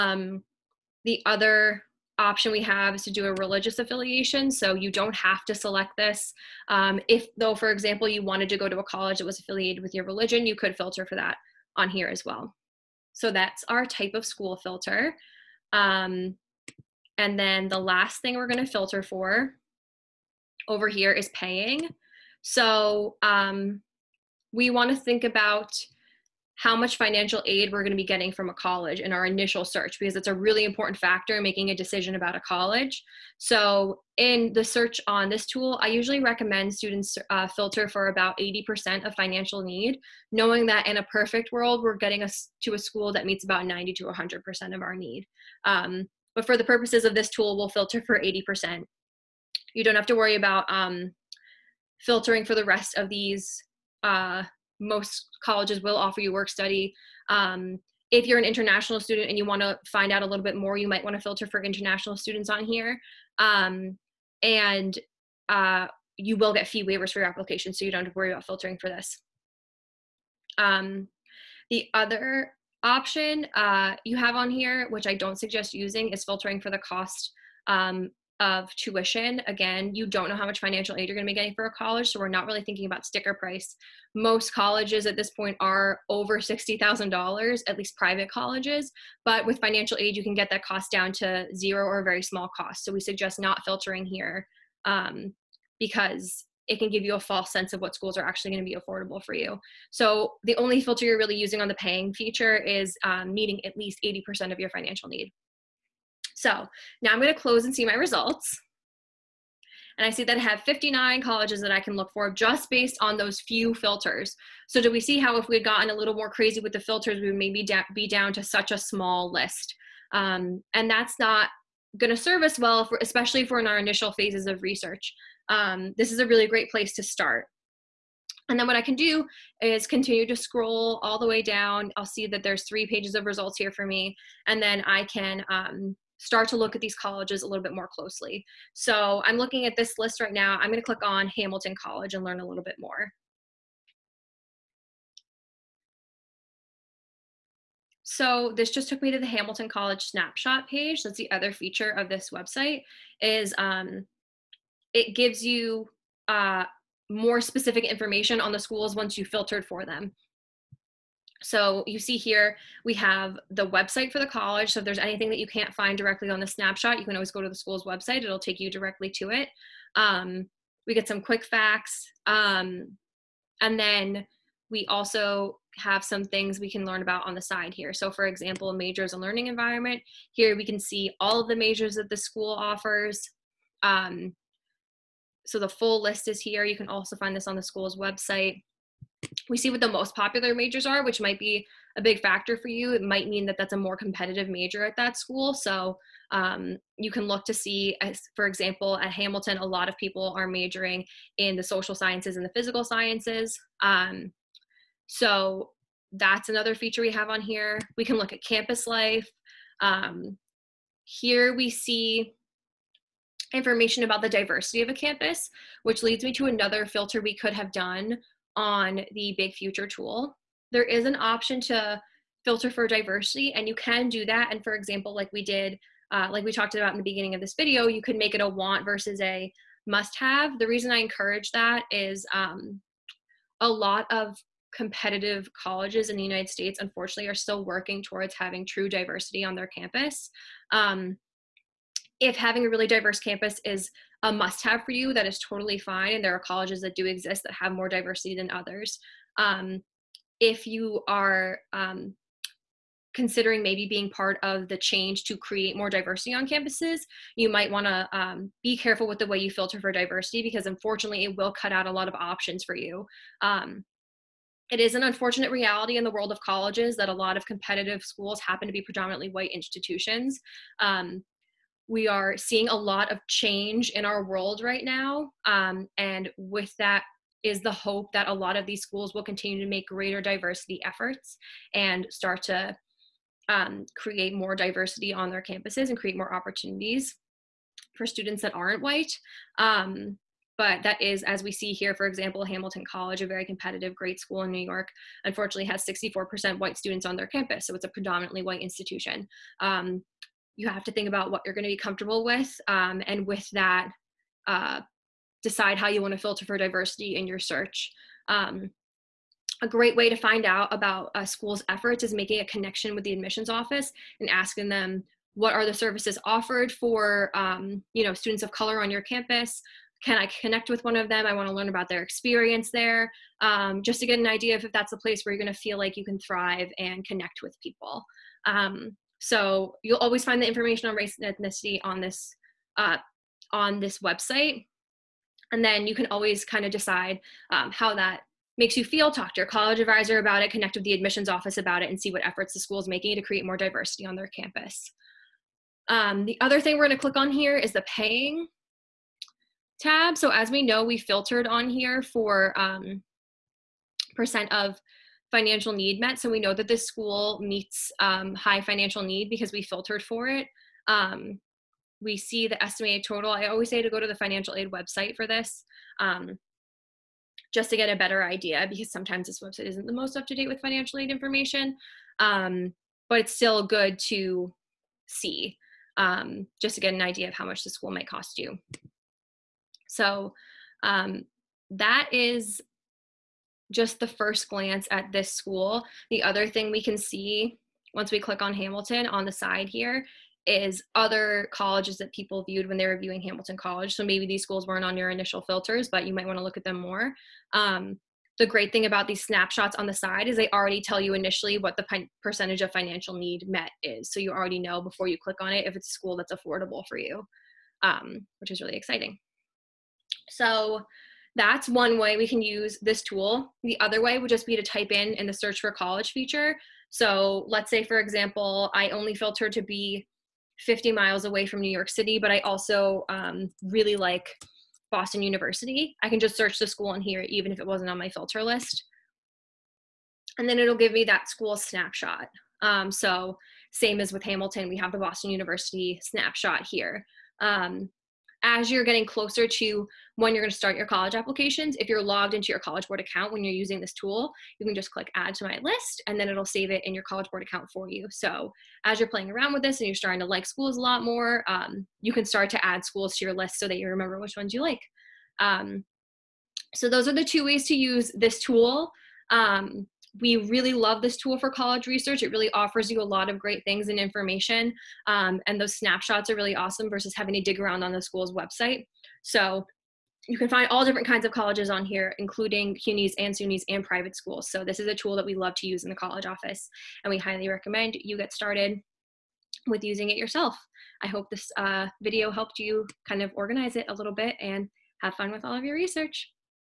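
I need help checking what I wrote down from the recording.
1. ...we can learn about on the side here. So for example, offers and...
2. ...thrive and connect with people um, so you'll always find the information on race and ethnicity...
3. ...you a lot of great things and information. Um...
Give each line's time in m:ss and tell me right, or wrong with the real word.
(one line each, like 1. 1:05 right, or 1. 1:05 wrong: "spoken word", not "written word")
1. 2:56 wrong: "majors", not "offers"
2. 5:26 right
3. 7:42 right.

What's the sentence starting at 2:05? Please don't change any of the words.
Um, this is a really great place to start.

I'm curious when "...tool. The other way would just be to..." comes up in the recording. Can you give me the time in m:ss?
6:53.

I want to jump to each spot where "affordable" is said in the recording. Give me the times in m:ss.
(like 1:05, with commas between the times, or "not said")
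1:38, 6:46.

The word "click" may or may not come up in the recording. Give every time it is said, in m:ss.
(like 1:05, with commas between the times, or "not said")
2:20, 5:47, 6:28, 6:45, 7:24.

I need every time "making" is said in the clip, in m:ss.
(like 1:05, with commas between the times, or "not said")
0:31, 5:12, 5:42.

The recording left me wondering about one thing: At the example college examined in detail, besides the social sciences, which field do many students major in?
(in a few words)
physical sciences.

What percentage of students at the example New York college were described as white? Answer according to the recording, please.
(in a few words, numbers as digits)
64%.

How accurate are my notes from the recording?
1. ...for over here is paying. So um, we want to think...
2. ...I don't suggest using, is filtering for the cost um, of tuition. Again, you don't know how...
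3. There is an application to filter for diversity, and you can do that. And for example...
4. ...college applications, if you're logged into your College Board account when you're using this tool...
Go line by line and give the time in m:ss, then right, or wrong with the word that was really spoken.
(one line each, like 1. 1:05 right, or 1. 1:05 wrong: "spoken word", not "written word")
1. 0:19 right
2. 1:15 right
3. 3:40 wrong: "option", not "application"
4. 7:20 right.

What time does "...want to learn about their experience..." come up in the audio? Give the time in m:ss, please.
5:21.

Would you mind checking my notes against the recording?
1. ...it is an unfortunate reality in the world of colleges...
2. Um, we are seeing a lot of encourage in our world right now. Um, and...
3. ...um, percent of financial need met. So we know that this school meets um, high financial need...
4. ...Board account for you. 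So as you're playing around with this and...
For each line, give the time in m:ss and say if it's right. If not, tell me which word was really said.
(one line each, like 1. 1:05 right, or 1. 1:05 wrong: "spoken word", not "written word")
1. 4:24 right
2. 4:30 wrong: "change", not "encourage"
3. 5:52 right
4. 7:27 right.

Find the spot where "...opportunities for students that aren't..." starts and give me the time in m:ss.
4:46.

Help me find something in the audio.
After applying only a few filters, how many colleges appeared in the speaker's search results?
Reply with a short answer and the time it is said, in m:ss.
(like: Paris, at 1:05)
59, at 1:50.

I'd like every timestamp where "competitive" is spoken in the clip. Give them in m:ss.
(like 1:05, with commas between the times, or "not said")
3:13, 3:54, 4:27, 4:53.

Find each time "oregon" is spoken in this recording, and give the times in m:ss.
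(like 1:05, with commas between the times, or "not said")
not said.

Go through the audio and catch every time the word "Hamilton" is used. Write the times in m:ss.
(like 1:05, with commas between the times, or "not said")
2:21, 2:29, 3:19, 4:52, 6:28, 6:33, 7:14.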